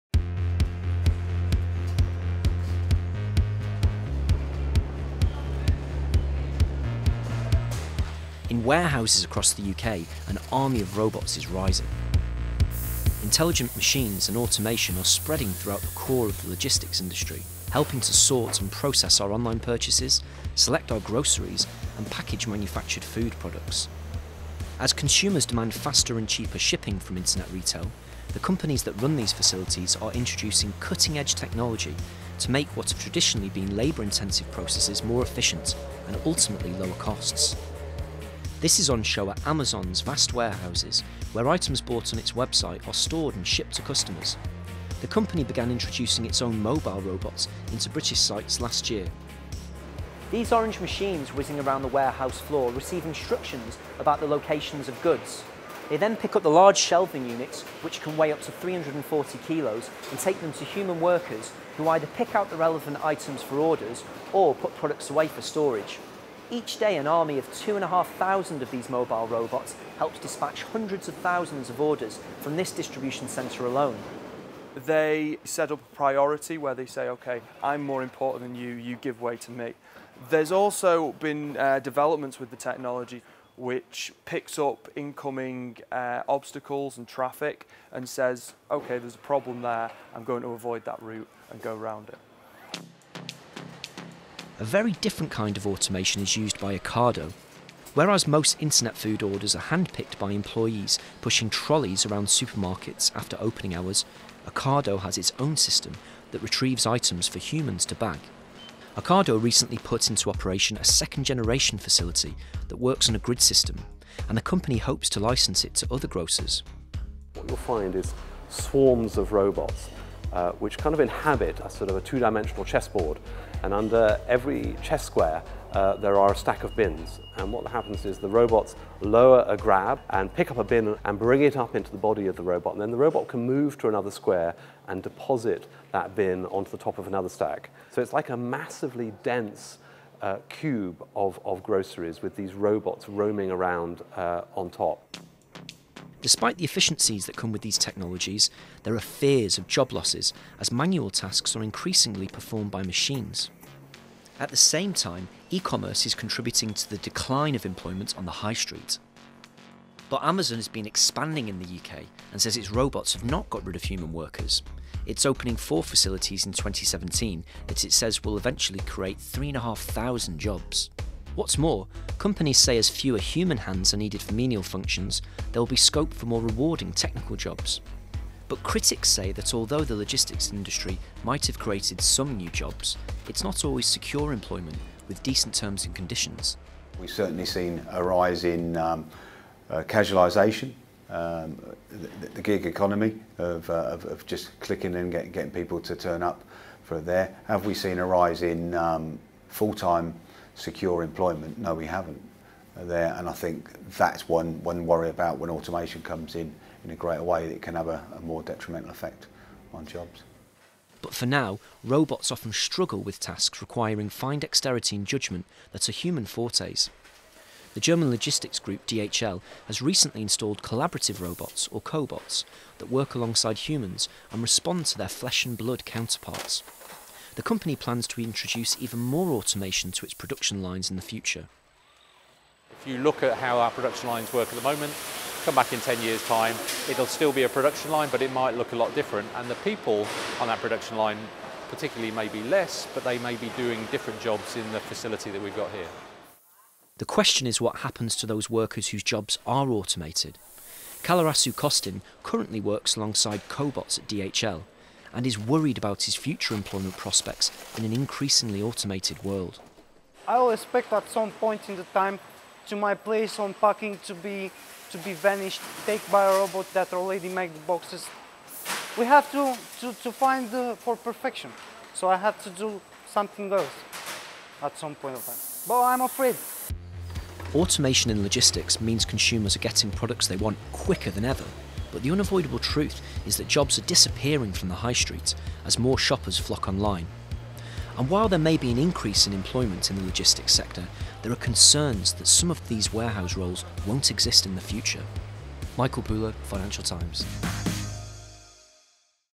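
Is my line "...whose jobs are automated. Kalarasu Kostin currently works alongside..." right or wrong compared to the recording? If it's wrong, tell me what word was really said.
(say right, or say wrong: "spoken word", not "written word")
right.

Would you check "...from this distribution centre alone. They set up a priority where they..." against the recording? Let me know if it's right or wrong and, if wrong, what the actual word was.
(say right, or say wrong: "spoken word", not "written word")
right.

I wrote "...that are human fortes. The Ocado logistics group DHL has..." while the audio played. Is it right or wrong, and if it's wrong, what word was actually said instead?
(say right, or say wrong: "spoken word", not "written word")
wrong: "German", not "Ocado".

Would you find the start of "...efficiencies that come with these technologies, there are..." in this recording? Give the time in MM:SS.
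02:26.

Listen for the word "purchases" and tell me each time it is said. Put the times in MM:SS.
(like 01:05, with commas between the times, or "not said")
00:19.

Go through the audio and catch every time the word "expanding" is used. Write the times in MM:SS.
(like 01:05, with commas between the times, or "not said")
02:40.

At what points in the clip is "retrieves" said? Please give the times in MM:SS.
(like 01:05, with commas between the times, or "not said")
01:46.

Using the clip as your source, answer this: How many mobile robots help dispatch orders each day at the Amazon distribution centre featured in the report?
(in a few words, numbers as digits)
2,500.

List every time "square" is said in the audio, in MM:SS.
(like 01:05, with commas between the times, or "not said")
02:05, 02:14.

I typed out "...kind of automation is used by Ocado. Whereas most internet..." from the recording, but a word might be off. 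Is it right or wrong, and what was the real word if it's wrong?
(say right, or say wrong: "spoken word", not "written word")
right.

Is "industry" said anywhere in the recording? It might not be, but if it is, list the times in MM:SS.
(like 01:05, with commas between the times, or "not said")
00:16, 03:00.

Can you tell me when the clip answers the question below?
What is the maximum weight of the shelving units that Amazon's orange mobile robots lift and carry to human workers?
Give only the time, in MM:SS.
00:58.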